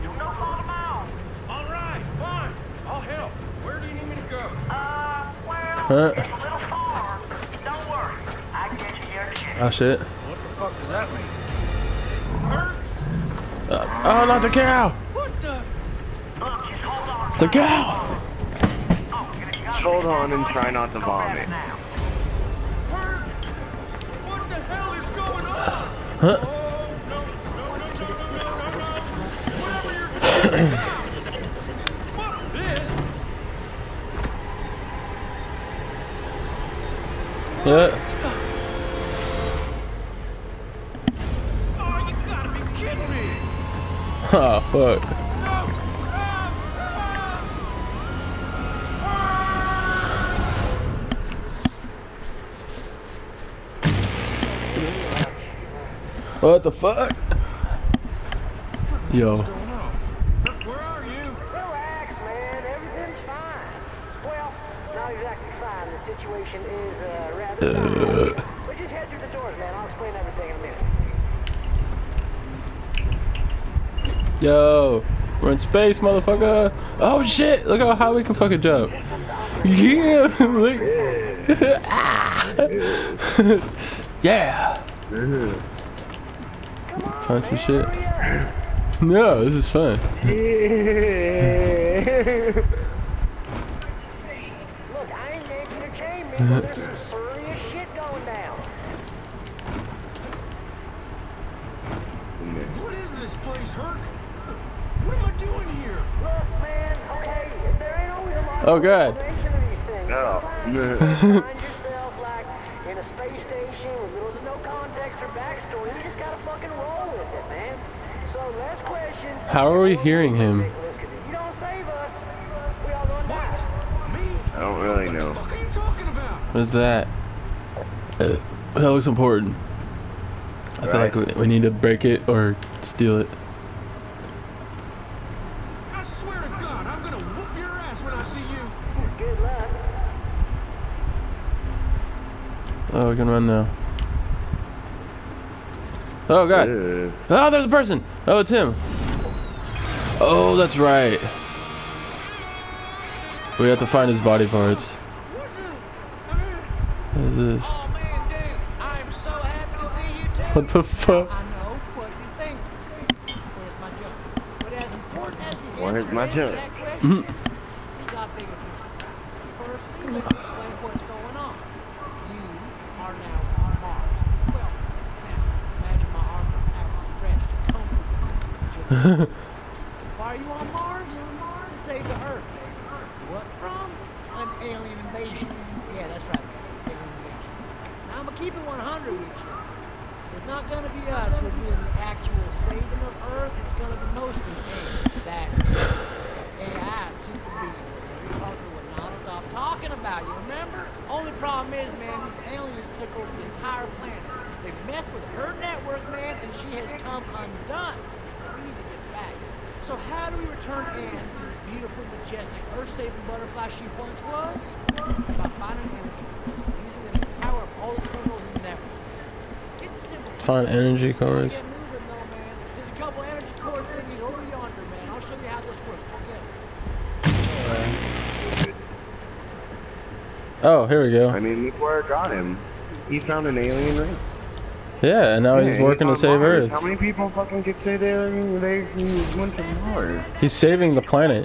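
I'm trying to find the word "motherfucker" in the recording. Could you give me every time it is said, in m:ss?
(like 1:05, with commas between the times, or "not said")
1:15.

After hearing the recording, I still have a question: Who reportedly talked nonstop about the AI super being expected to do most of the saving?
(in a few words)
Larry Parker.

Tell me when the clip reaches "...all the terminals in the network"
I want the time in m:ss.
3:37.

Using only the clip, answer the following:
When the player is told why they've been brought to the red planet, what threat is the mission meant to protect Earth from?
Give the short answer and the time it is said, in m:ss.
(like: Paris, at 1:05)
An alien invasion, at 3:04.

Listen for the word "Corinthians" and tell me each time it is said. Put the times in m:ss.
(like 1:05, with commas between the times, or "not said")
not said.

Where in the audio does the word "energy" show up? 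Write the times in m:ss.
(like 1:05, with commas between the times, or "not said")
3:35, 3:40.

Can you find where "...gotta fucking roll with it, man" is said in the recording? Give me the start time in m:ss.
1:56.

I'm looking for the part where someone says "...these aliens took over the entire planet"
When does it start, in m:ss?
3:22.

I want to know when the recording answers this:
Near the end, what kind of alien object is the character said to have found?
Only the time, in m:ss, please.
3:53.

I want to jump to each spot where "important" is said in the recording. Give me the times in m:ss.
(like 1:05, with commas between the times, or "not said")
2:09, 2:44.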